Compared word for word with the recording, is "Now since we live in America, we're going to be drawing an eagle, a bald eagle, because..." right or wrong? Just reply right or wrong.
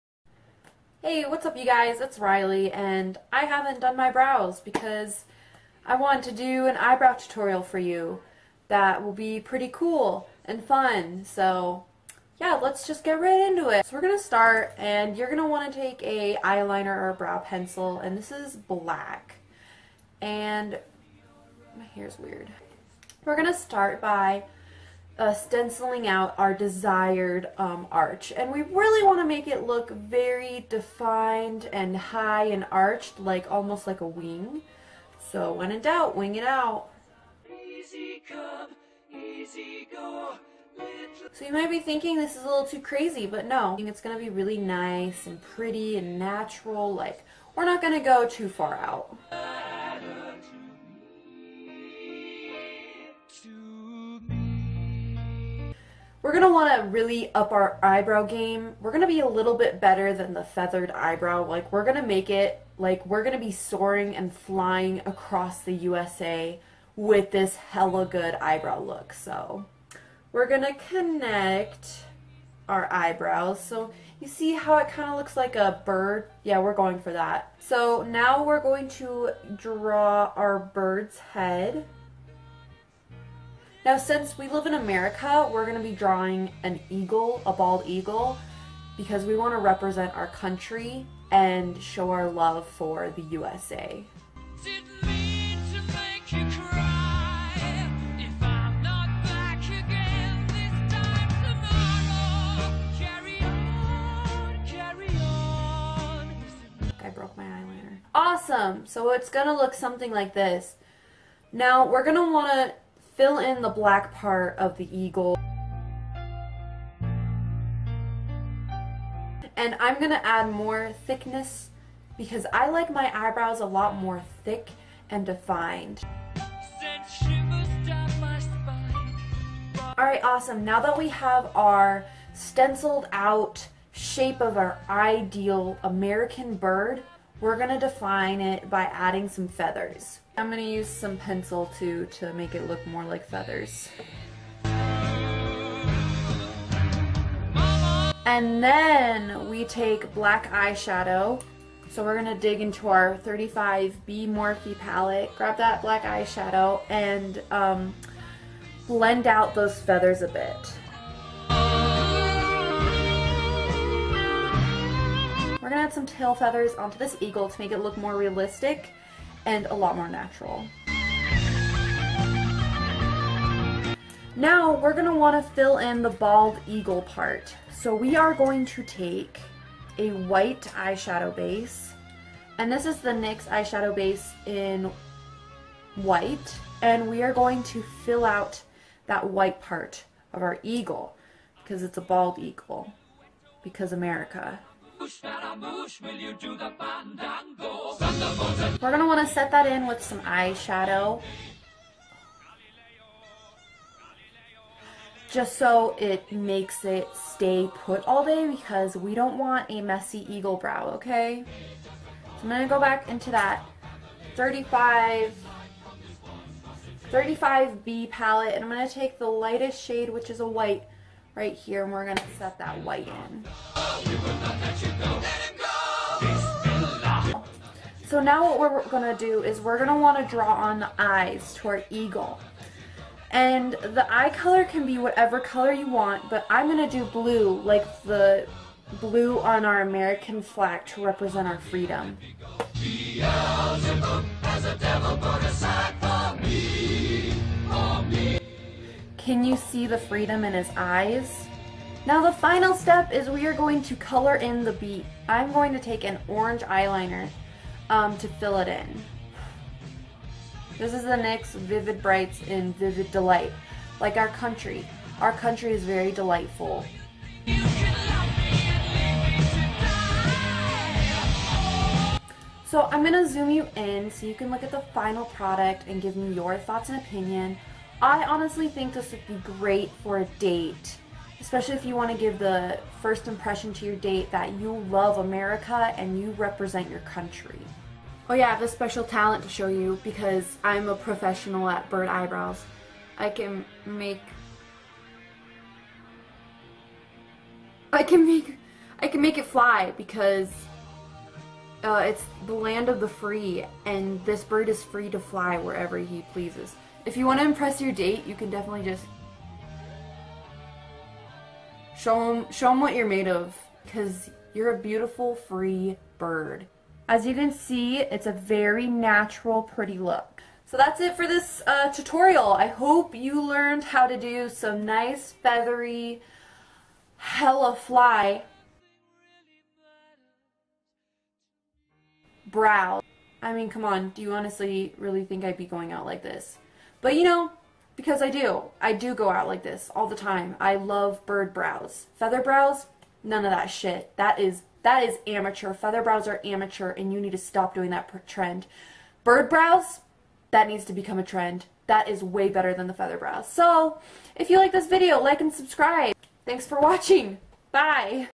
right.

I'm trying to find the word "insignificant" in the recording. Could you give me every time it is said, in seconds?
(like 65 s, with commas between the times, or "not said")
not said.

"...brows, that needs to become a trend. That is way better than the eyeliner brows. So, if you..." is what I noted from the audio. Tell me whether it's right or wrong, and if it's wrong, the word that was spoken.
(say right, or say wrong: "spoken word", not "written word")
wrong: "feather", not "eyeliner".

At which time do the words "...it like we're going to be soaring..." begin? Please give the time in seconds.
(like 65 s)
62 s.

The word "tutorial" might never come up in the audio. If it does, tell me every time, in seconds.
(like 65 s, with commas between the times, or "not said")
7 s, 321 s.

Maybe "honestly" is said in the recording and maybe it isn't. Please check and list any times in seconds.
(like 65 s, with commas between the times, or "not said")
278 s, 334 s.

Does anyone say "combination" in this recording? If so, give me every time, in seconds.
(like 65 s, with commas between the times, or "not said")
not said.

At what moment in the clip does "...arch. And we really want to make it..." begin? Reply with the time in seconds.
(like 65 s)
27 s.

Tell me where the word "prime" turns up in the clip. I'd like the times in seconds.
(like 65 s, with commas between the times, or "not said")
not said.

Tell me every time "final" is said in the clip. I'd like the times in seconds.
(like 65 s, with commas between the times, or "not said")
252 s, 274 s.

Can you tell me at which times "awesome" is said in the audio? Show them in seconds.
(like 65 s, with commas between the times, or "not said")
108 s, 130 s.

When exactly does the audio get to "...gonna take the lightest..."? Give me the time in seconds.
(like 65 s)
218 s.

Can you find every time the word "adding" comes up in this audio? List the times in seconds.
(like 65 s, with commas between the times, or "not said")
138 s.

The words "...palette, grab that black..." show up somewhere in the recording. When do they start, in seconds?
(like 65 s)
154 s.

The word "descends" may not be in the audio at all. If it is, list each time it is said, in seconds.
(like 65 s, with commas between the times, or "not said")
not said.